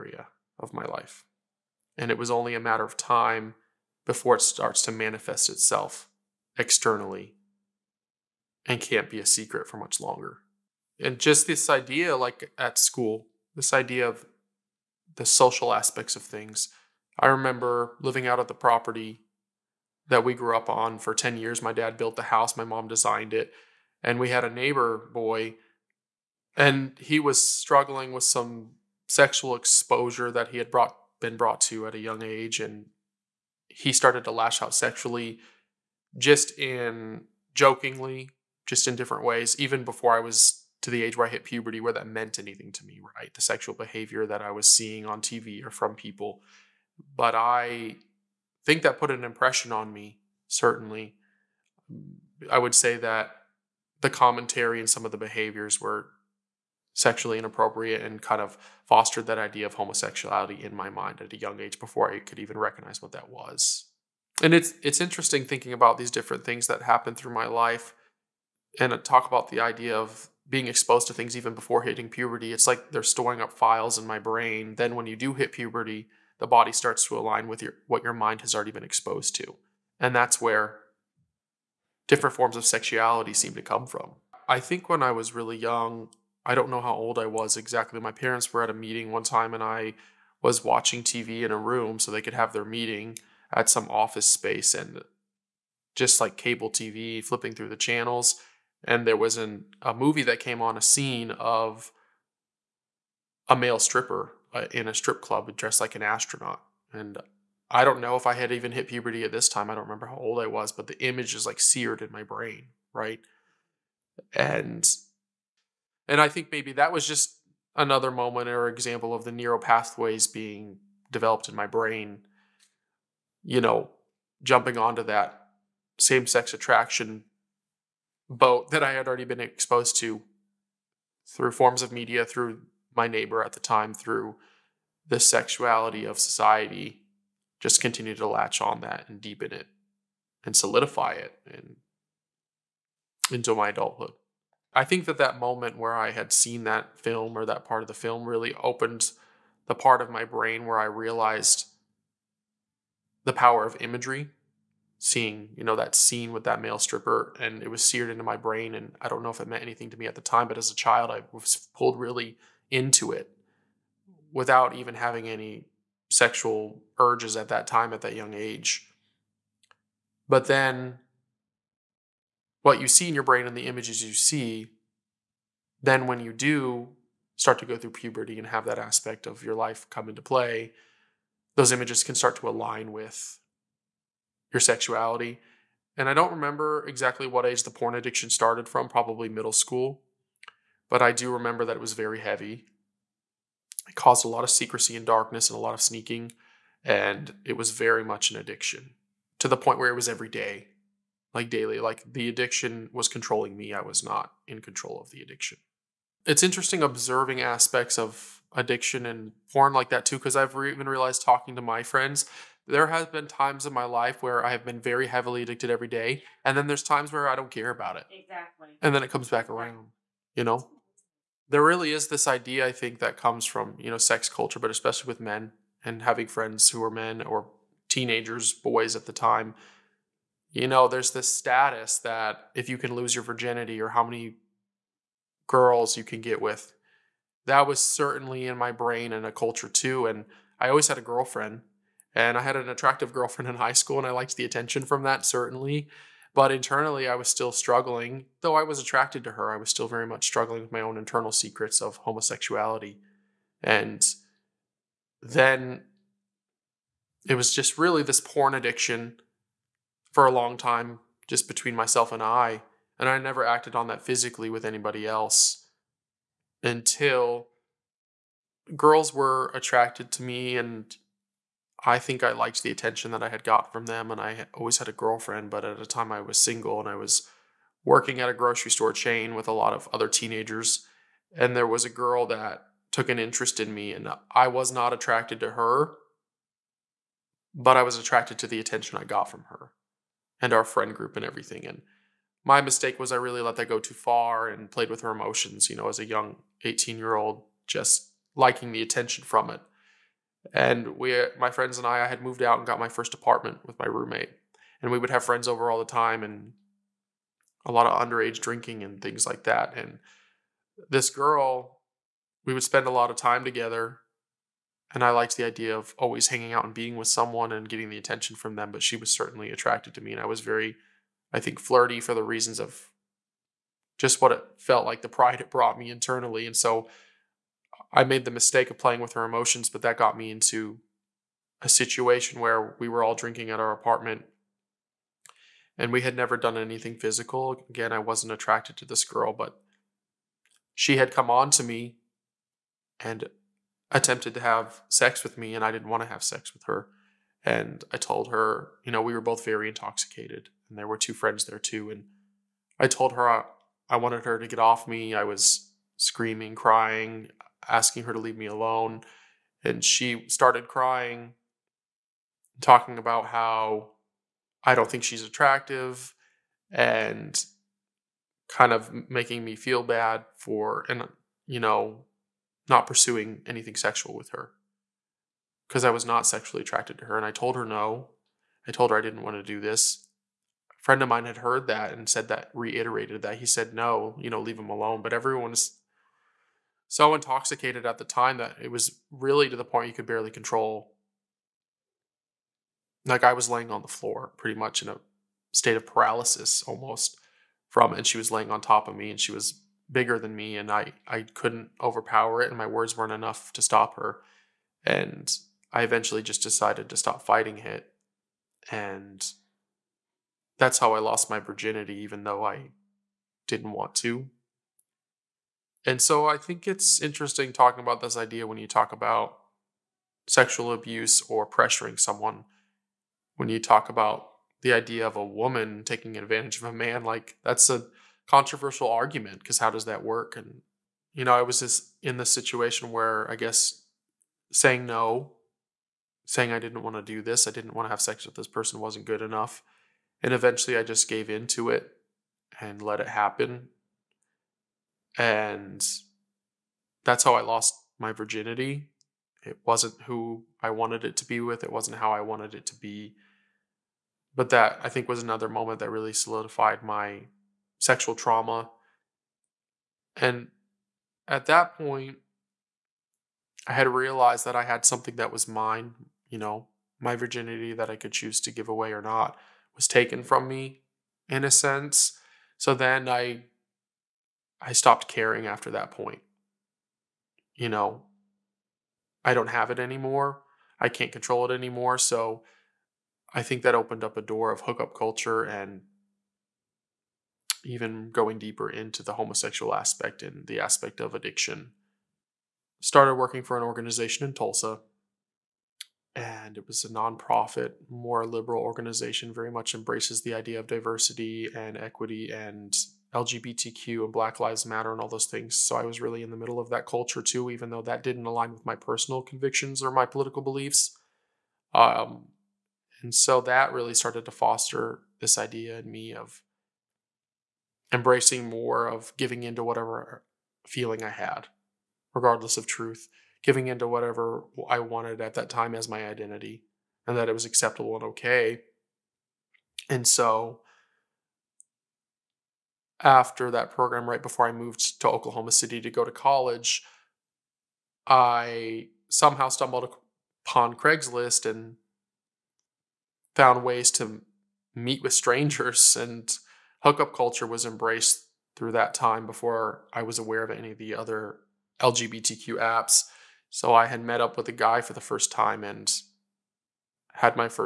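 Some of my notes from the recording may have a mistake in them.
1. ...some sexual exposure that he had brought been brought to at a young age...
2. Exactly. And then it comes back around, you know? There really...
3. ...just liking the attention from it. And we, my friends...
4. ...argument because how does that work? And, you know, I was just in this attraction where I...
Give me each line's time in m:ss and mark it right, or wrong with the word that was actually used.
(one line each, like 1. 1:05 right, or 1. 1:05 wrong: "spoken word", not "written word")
1. 0:28 right
2. 3:38 right
3. 4:57 right
4. 7:08 wrong: "situation", not "attraction".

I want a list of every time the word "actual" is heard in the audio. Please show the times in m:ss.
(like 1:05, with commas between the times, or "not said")
not said.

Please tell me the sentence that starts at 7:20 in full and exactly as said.
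And eventually I just gave in to it and let it happen and that's how I lost my virginity.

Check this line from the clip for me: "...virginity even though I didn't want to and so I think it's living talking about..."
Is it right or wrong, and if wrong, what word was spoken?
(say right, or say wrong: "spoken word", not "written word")
wrong: "interesting", not "living".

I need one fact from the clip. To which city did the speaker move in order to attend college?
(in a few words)
Oklahoma City.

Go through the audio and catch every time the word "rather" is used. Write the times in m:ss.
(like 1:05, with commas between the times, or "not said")
not said.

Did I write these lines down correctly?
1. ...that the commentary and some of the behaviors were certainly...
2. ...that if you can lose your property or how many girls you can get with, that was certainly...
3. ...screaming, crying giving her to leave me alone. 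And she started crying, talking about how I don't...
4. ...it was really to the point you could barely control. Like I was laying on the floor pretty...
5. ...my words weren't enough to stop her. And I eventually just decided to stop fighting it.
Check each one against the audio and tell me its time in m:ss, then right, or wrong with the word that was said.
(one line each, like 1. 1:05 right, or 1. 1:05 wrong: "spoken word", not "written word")
1. 0:52 wrong: "sexually", not "certainly"
2. 3:51 wrong: "virginity", not "property"
3. 5:55 wrong: "asking", not "giving"
4. 6:28 right
5. 6:42 right.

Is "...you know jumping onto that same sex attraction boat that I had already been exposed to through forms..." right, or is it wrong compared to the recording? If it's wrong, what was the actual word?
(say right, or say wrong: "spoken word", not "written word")
right.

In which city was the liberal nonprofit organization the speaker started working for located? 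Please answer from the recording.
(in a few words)
Tulsa.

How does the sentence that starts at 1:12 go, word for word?
It's like they're storing up files in my brain.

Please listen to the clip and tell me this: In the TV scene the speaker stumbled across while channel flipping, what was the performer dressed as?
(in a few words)
An astronaut.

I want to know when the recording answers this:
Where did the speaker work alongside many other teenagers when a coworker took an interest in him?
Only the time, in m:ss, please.
4:38.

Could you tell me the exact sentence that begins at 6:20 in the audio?
A friend of mine had heard that and said that, reiterated that.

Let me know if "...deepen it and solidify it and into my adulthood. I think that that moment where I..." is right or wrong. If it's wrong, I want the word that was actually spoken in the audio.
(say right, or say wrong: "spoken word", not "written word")
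right.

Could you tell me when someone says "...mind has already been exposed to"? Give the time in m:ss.
1:18.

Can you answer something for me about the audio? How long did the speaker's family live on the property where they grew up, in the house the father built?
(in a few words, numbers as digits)
10 years.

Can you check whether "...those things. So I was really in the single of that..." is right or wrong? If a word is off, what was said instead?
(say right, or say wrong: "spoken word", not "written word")
wrong: "middle", not "single".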